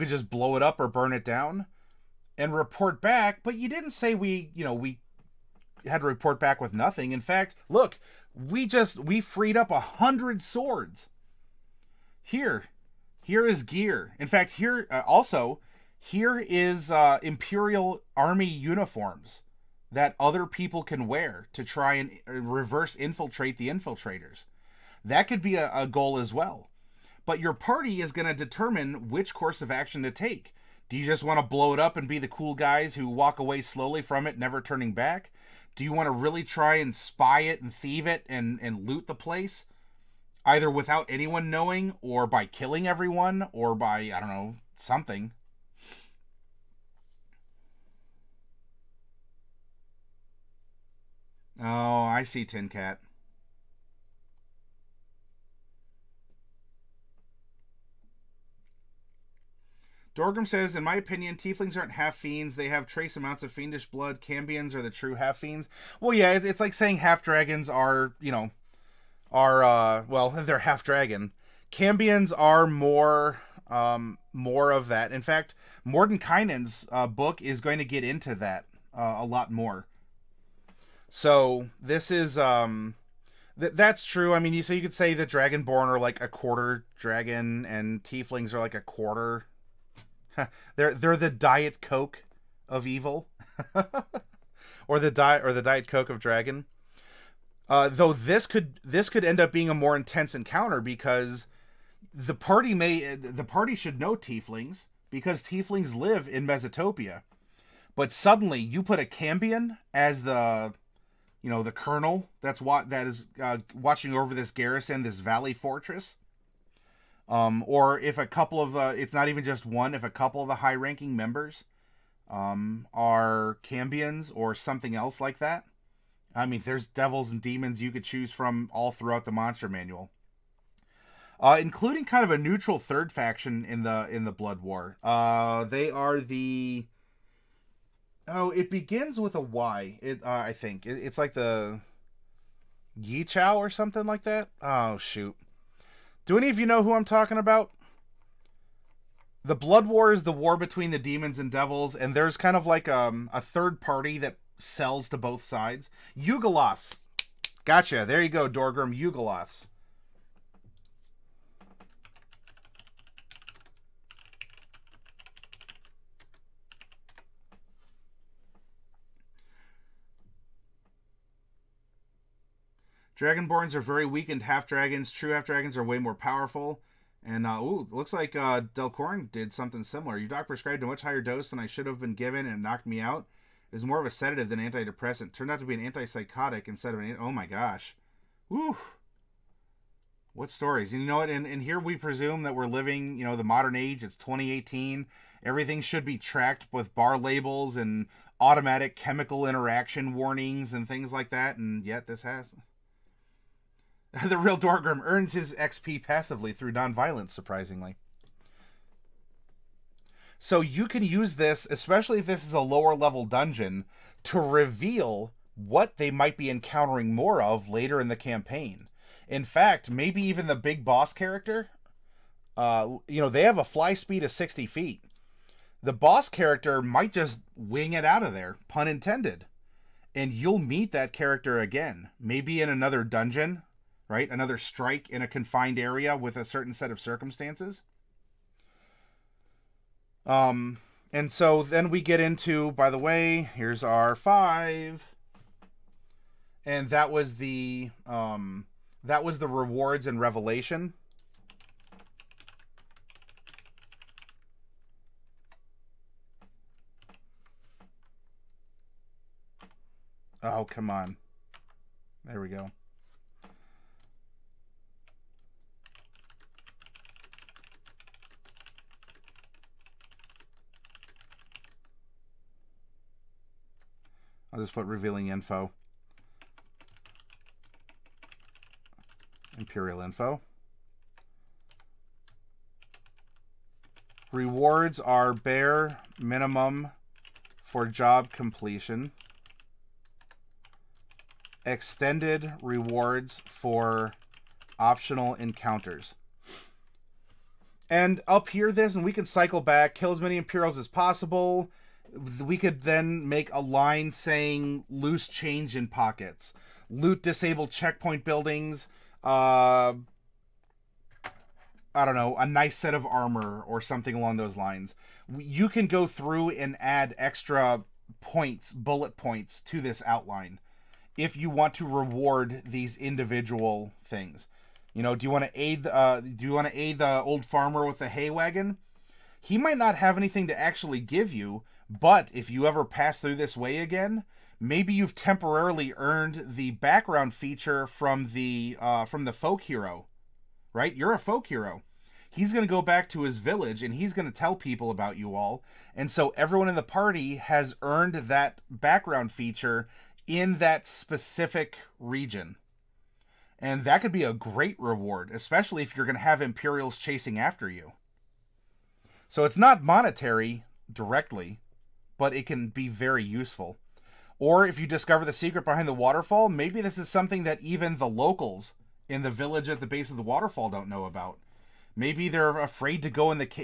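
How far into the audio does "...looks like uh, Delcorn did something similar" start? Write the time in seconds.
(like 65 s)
177 s.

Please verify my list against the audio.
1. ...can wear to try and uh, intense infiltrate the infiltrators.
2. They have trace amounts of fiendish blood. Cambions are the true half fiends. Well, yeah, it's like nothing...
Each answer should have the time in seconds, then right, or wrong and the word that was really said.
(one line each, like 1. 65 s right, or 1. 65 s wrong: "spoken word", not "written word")
1. 20 s wrong: "reverse", not "intense"
2. 62 s wrong: "saying", not "nothing".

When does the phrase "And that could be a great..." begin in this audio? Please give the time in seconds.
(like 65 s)
353 s.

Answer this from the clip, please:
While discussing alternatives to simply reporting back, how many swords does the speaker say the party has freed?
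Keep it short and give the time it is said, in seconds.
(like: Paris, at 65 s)
100, at 9 s.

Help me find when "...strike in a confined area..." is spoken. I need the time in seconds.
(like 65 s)
234 s.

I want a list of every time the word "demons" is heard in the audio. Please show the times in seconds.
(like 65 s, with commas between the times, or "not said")
127 s, 150 s.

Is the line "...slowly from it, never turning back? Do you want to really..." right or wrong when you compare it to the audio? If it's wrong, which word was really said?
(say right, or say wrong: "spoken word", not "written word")
right.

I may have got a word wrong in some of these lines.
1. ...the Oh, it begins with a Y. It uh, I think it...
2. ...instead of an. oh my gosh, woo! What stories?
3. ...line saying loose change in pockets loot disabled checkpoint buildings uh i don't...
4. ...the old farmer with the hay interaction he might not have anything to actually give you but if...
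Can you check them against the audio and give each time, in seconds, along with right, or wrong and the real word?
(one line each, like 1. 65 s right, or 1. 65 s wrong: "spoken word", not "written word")
1. 136 s right
2. 186 s right
3. 303 s right
4. 326 s wrong: "wagon", not "interaction".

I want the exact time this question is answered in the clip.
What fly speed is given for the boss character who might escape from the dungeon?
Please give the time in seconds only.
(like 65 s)
224 s.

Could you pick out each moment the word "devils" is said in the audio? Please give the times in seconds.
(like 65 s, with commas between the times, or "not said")
126 s, 151 s.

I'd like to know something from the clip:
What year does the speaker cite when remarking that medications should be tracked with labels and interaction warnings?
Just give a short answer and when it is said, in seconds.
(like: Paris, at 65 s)
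2018, at 194 s.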